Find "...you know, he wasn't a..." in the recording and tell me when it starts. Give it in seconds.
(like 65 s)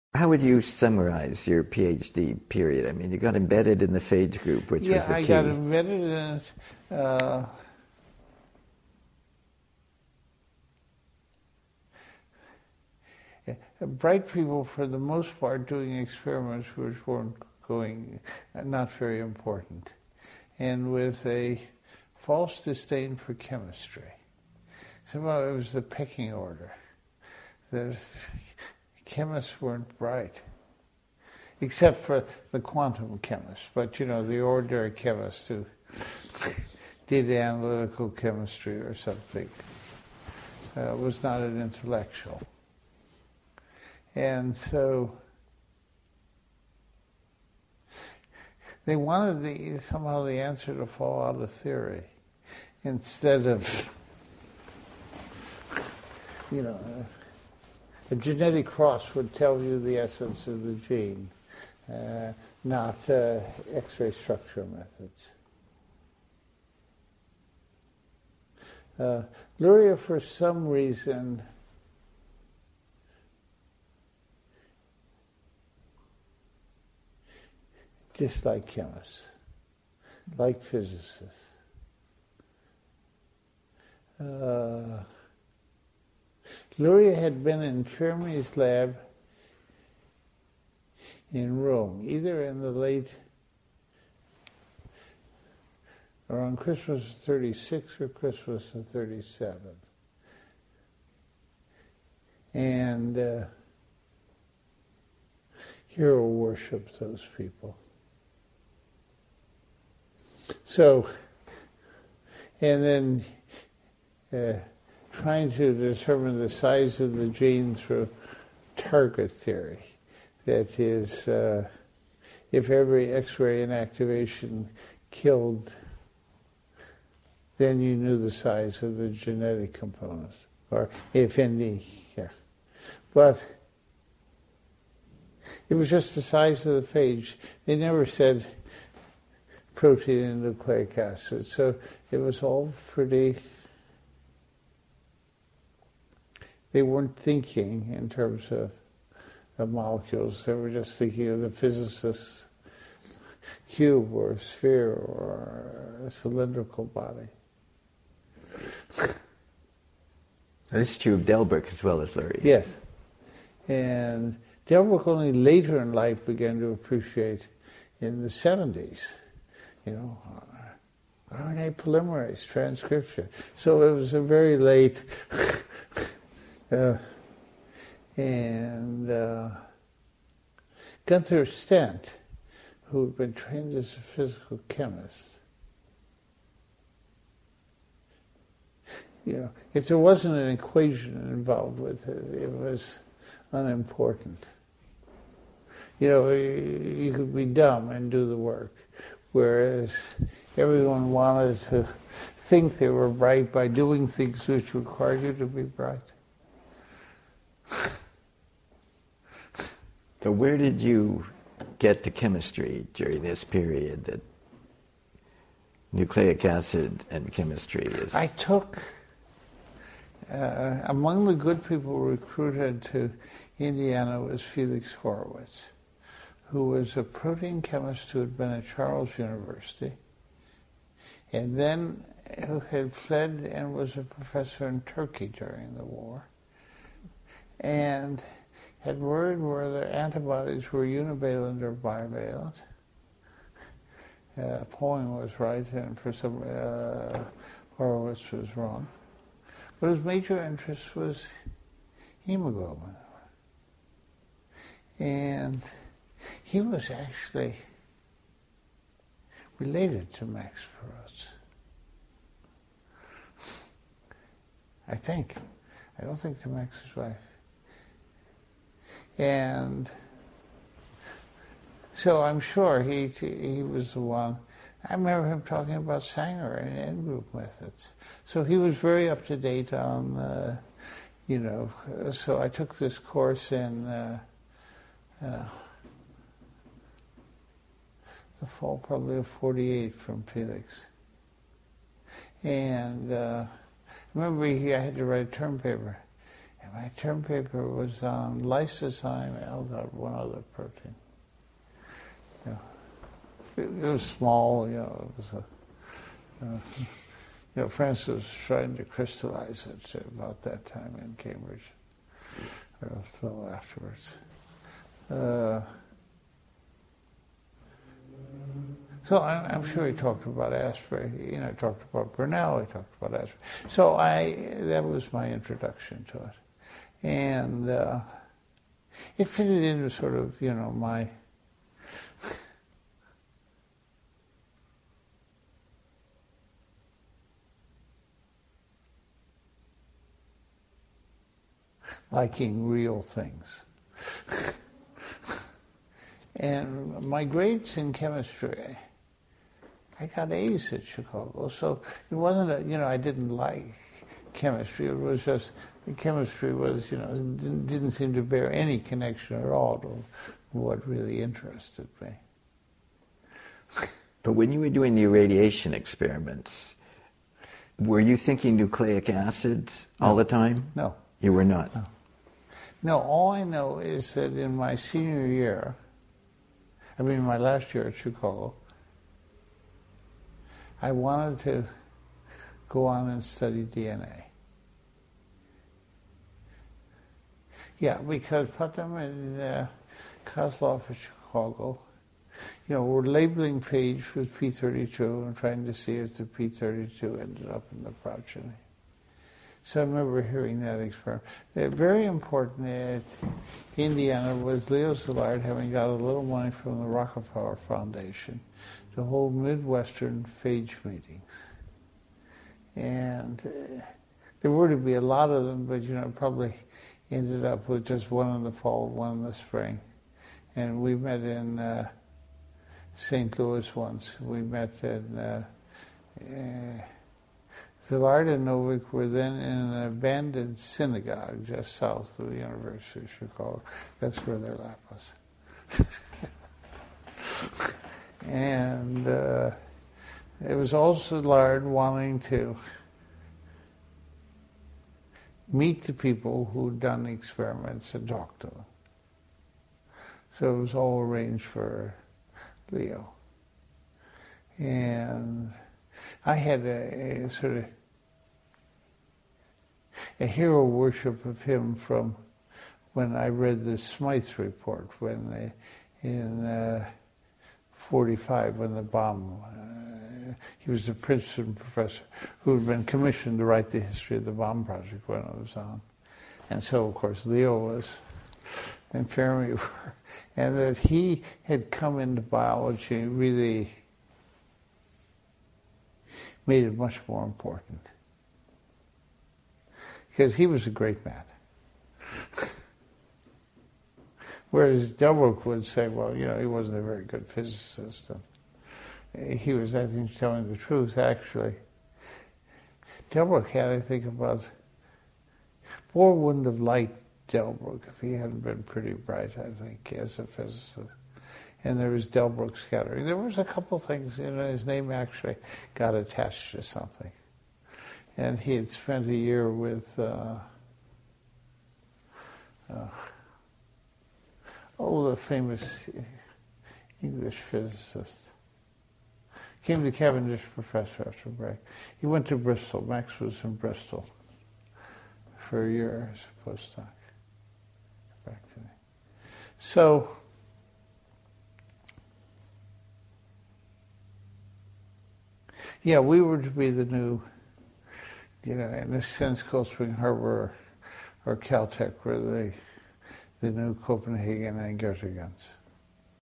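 496 s.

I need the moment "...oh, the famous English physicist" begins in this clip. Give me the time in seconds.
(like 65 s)
524 s.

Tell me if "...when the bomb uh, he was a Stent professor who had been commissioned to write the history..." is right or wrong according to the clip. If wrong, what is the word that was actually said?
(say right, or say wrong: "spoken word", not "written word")
wrong: "Princeton", not "Stent".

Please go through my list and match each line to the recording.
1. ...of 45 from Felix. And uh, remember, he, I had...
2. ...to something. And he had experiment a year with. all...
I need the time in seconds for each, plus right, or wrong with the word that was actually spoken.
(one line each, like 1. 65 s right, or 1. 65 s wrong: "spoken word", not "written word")
1. 289 s wrong: "48", not "45"
2. 516 s wrong: "spent", not "experiment".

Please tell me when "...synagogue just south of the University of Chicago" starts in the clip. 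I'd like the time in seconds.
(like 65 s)
430 s.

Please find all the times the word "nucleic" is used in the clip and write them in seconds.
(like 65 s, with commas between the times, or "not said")
140 s, 215 s, 368 s.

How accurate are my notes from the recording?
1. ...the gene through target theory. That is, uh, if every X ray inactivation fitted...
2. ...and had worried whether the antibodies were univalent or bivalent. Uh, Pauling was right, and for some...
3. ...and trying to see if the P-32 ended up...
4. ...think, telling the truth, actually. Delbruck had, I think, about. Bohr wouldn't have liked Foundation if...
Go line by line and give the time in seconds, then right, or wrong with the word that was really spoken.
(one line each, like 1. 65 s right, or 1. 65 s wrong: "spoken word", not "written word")
1. 117 s wrong: "killed", not "fitted"
2. 237 s right
3. 394 s right
4. 499 s wrong: "Delbruck", not "Foundation".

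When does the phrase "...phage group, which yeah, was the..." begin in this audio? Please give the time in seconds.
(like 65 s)
3 s.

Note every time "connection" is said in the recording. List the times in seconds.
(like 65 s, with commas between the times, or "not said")
358 s.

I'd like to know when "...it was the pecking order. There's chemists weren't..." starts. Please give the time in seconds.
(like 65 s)
25 s.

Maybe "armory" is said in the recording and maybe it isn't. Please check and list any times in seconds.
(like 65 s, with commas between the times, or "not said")
not said.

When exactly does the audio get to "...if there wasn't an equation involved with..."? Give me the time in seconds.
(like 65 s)
189 s.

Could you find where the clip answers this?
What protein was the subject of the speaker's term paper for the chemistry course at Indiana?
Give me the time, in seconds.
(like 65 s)
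298 s.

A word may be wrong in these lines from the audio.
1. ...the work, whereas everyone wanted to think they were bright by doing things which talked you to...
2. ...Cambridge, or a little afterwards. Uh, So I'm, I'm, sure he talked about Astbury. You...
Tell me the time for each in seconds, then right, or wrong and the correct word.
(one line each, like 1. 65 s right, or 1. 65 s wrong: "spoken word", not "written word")
1. 198 s wrong: "required", not "talked"
2. 311 s right.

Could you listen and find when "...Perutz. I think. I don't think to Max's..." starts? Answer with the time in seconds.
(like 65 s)
260 s.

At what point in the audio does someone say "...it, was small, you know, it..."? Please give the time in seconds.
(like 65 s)
303 s.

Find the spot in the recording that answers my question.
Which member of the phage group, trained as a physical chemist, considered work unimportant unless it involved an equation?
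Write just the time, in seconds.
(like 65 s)
181 s.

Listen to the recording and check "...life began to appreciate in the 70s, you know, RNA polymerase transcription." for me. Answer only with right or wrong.
right.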